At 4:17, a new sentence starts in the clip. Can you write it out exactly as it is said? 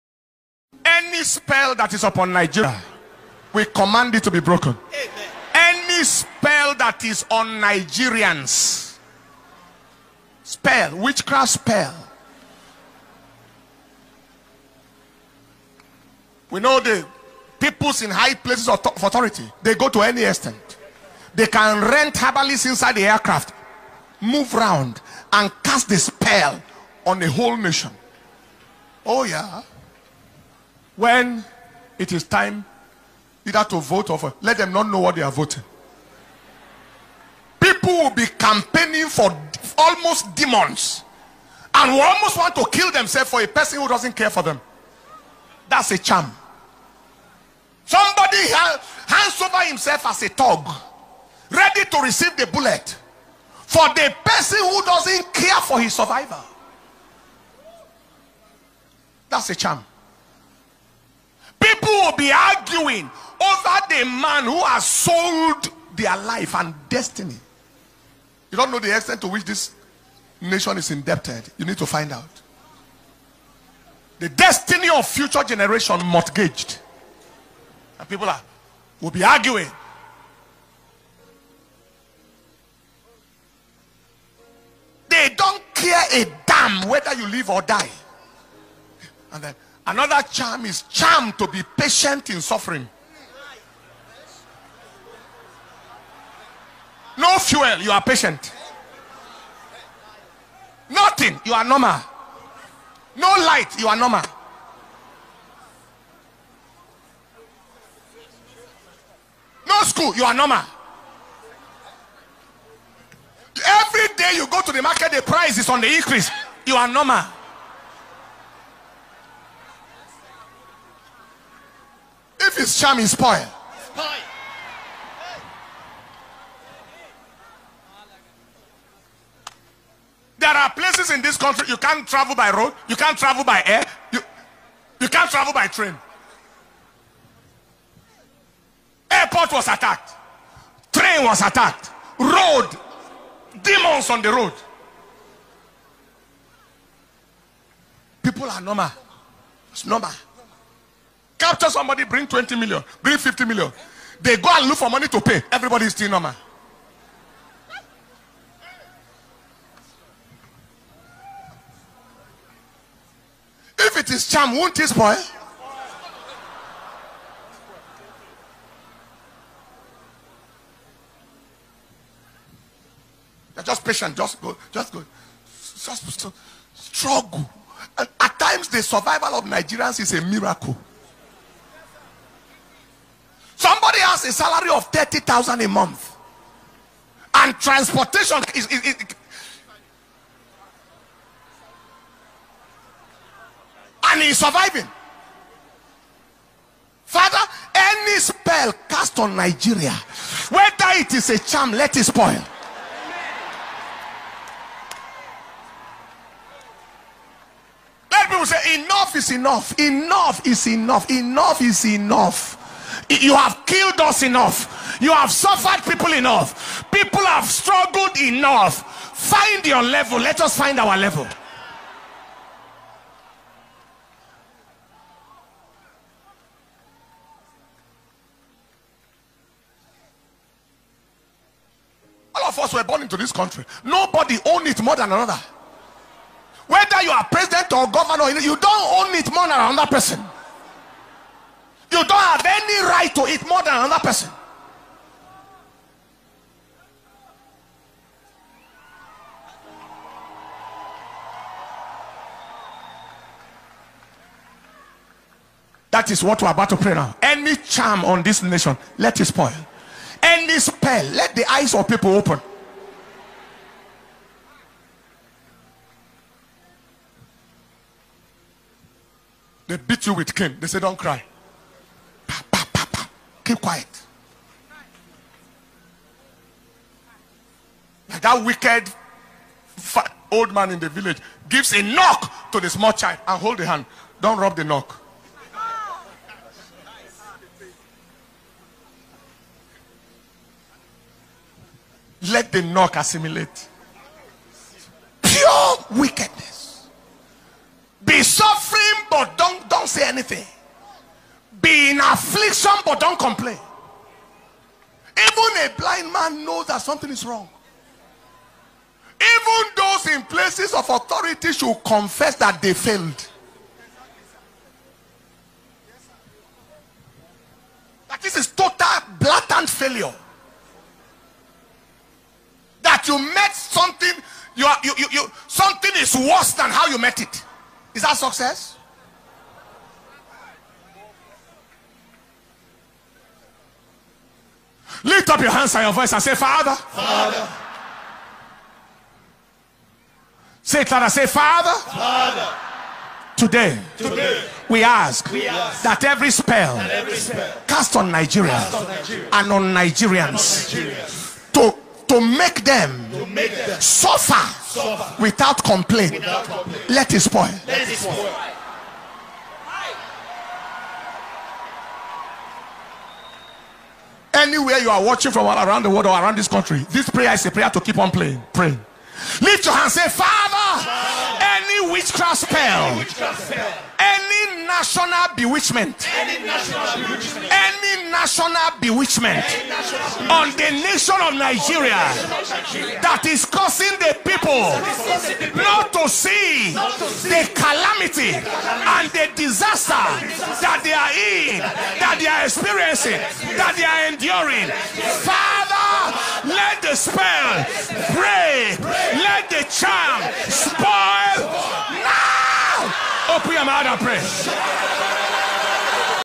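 Any charm on this nation, let it spoil.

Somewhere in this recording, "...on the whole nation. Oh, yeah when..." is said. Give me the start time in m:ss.
0:27.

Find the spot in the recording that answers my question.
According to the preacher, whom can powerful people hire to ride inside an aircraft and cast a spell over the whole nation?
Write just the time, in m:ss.
0:22.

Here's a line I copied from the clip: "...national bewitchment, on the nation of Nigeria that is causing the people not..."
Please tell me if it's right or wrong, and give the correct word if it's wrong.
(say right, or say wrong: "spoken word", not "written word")
right.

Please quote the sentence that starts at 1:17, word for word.
And people are, will be arguing.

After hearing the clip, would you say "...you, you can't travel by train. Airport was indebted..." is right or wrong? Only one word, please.
wrong.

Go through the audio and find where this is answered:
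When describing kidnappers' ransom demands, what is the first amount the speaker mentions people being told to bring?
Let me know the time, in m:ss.
2:32.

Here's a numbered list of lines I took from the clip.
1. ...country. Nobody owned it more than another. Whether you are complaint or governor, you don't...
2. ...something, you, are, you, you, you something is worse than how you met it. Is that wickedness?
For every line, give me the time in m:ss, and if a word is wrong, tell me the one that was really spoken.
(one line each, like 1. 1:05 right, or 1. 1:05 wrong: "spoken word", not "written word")
1. 3:53 wrong: "president", not "complaint"
2. 5:23 wrong: "success", not "wickedness".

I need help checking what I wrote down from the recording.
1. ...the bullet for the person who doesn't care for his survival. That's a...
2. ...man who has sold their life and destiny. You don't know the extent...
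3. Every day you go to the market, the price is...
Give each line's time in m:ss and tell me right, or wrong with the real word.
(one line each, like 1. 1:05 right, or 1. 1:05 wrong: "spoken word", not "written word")
1. 0:52 right
2. 1:04 right
3. 1:53 right.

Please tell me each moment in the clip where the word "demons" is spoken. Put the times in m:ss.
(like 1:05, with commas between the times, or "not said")
0:40, 2:23.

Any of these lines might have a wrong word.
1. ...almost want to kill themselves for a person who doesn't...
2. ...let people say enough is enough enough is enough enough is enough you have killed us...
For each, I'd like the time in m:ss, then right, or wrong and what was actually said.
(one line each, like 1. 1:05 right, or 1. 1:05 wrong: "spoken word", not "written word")
1. 0:42 right
2. 3:28 right.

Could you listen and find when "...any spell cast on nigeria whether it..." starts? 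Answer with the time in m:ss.
3:17.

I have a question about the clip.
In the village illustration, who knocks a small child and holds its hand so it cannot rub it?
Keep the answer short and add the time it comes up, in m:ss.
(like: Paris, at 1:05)
wicked old man, at 4:38.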